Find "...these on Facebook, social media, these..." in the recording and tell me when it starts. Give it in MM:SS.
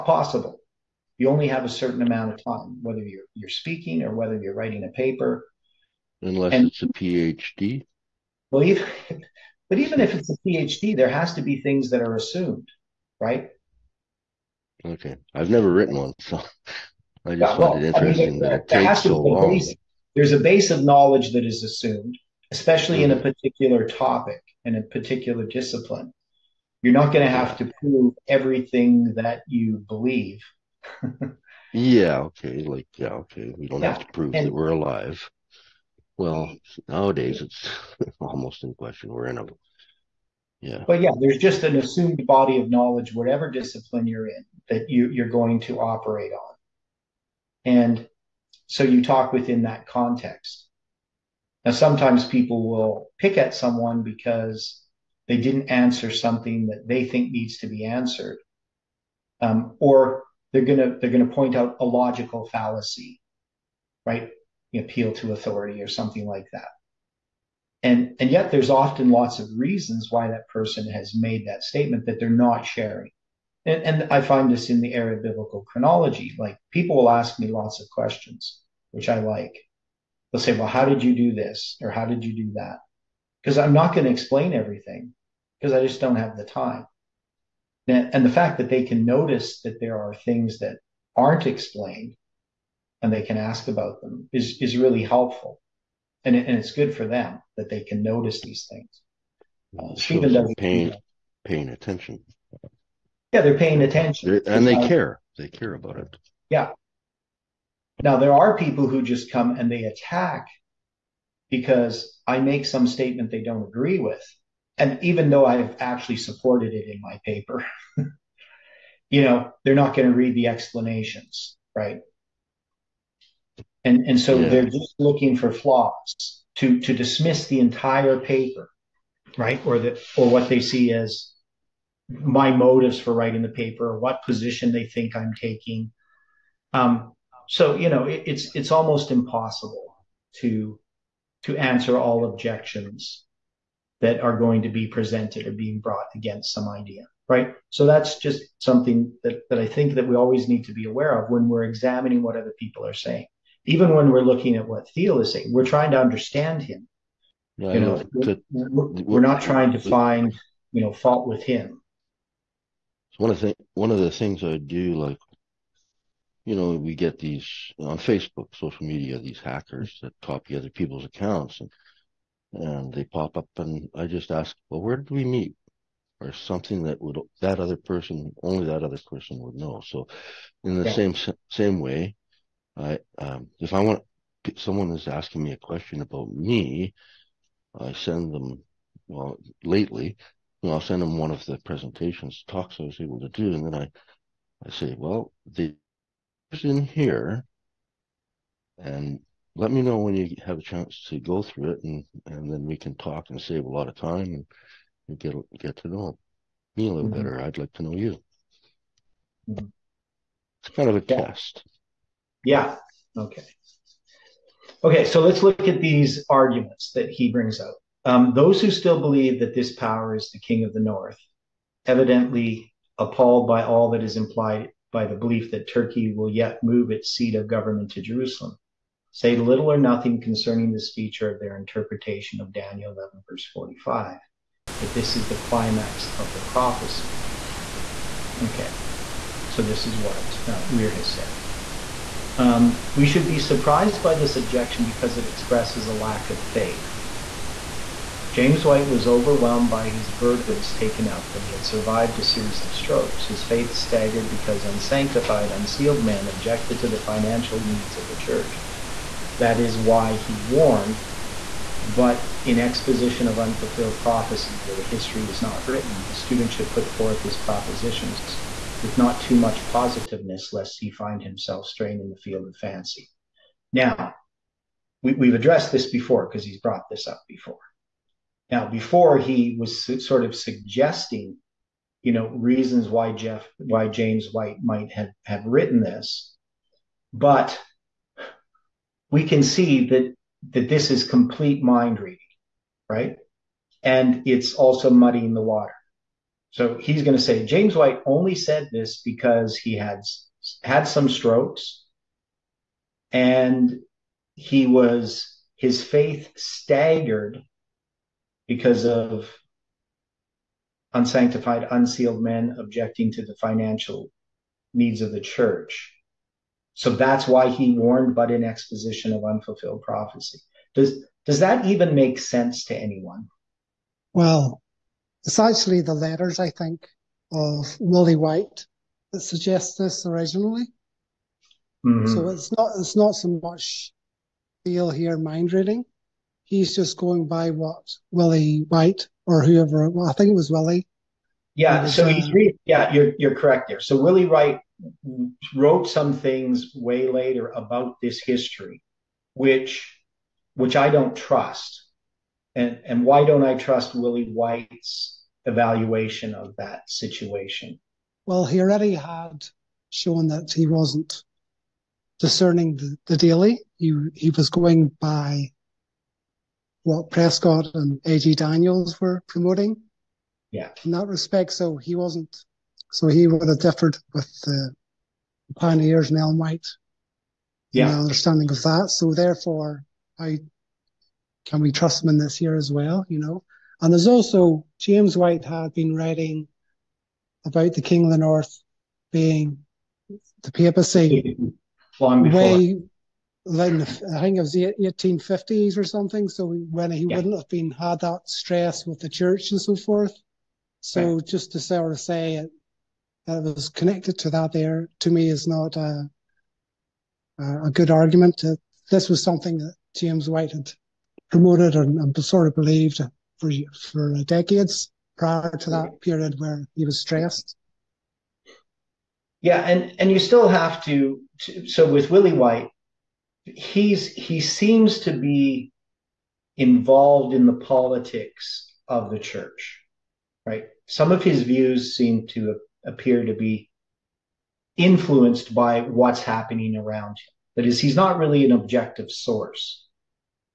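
02:47.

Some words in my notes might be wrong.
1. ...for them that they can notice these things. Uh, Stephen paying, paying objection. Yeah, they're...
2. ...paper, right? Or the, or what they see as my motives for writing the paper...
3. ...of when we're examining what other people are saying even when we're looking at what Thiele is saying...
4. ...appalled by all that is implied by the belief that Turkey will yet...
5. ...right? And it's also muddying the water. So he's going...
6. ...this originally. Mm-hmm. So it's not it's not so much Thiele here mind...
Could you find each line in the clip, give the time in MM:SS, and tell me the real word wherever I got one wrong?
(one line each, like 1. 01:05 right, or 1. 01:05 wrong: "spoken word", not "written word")
1. 01:36 wrong: "attention", not "objection"
2. 02:08 right
3. 02:31 right
4. 03:42 right
5. 04:52 right
6. 05:29 right.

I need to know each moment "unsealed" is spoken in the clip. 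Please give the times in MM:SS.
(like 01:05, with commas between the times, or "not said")
04:15, 05:11.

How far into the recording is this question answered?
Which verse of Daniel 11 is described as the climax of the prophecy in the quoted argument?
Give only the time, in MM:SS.
03:53.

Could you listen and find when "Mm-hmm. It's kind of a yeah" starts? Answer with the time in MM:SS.
03:29.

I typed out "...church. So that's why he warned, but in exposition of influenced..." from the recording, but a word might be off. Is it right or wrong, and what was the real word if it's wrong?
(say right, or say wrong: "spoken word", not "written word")
wrong: "unfulfilled", not "influenced".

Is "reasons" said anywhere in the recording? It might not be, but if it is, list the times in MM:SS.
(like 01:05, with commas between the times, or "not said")
01:09, 04:42.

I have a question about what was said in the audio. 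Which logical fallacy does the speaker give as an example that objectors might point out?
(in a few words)
Appeal to authority.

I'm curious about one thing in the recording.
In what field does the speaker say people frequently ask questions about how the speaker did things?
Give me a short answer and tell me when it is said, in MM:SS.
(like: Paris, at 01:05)
Biblical chronology, at 01:15.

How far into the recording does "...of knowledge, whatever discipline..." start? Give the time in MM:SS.
00:42.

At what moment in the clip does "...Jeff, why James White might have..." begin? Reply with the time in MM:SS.
04:43.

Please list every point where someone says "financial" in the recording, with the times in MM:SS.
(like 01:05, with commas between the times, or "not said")
04:17, 05:13.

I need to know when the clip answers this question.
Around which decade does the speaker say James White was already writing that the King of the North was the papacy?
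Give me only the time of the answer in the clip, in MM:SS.
06:34.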